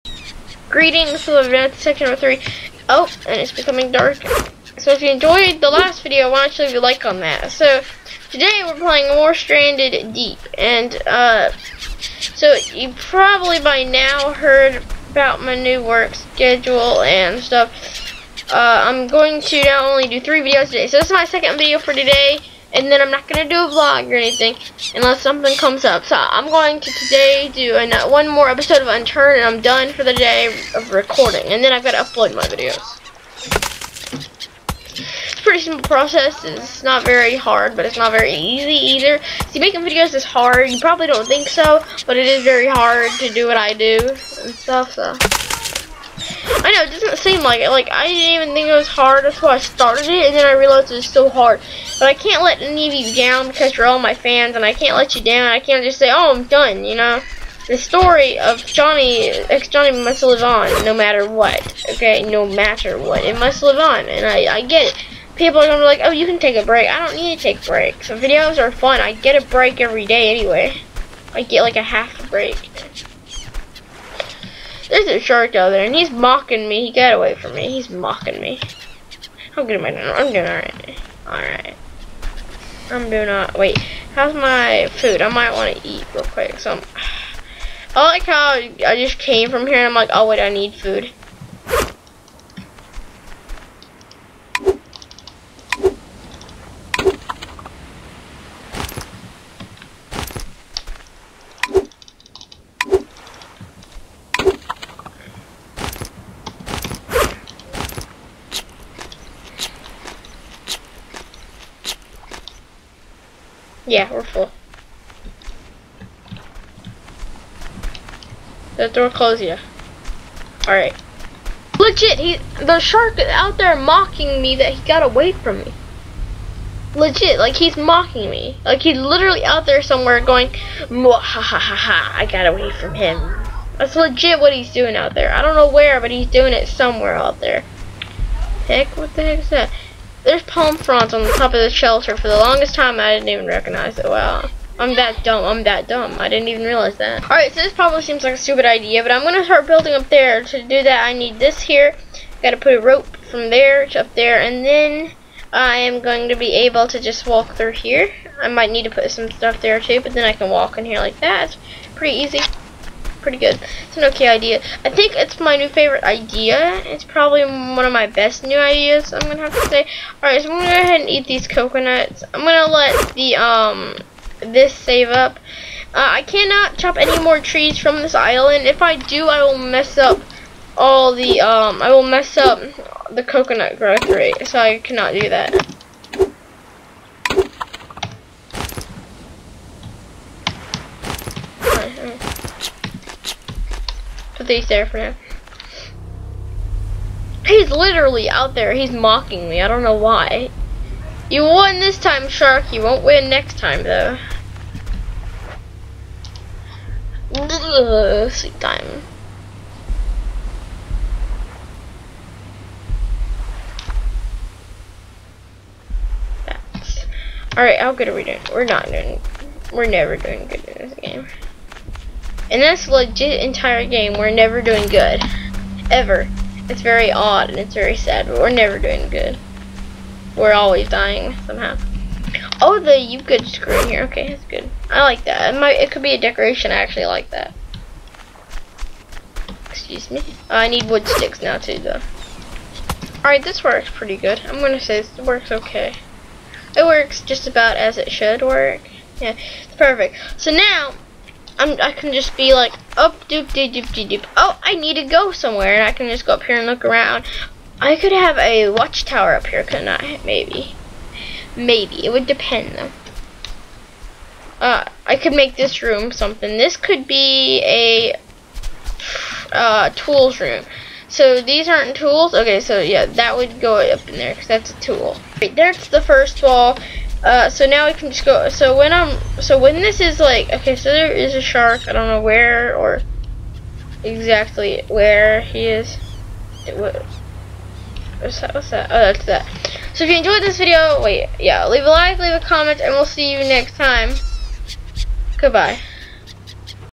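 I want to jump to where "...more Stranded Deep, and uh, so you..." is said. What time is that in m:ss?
0:09.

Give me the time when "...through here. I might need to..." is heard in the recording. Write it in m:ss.
2:37.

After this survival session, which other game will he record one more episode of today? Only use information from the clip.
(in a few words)
Unturned.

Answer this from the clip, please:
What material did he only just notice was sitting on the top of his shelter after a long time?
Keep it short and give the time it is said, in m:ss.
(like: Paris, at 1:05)
Palm fronds, at 2:20.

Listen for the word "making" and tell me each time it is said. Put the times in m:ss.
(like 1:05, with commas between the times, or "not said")
0:39.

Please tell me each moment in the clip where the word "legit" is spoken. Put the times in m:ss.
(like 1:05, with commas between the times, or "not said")
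2:01, 2:06, 2:13, 3:42.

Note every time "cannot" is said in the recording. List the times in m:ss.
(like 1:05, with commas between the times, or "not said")
2:56, 3:04.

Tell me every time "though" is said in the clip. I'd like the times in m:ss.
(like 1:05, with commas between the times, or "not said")
3:23, 4:01, 4:22.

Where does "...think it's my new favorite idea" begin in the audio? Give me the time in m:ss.
2:44.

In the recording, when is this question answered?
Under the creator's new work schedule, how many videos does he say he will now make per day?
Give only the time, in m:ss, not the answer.
0:20.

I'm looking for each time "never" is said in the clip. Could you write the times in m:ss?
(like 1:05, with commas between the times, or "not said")
3:39, 3:44, 3:48.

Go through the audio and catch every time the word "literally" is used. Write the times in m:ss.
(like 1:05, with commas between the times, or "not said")
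2:08, 3:17.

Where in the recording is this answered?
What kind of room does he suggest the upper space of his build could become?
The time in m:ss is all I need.
4:29.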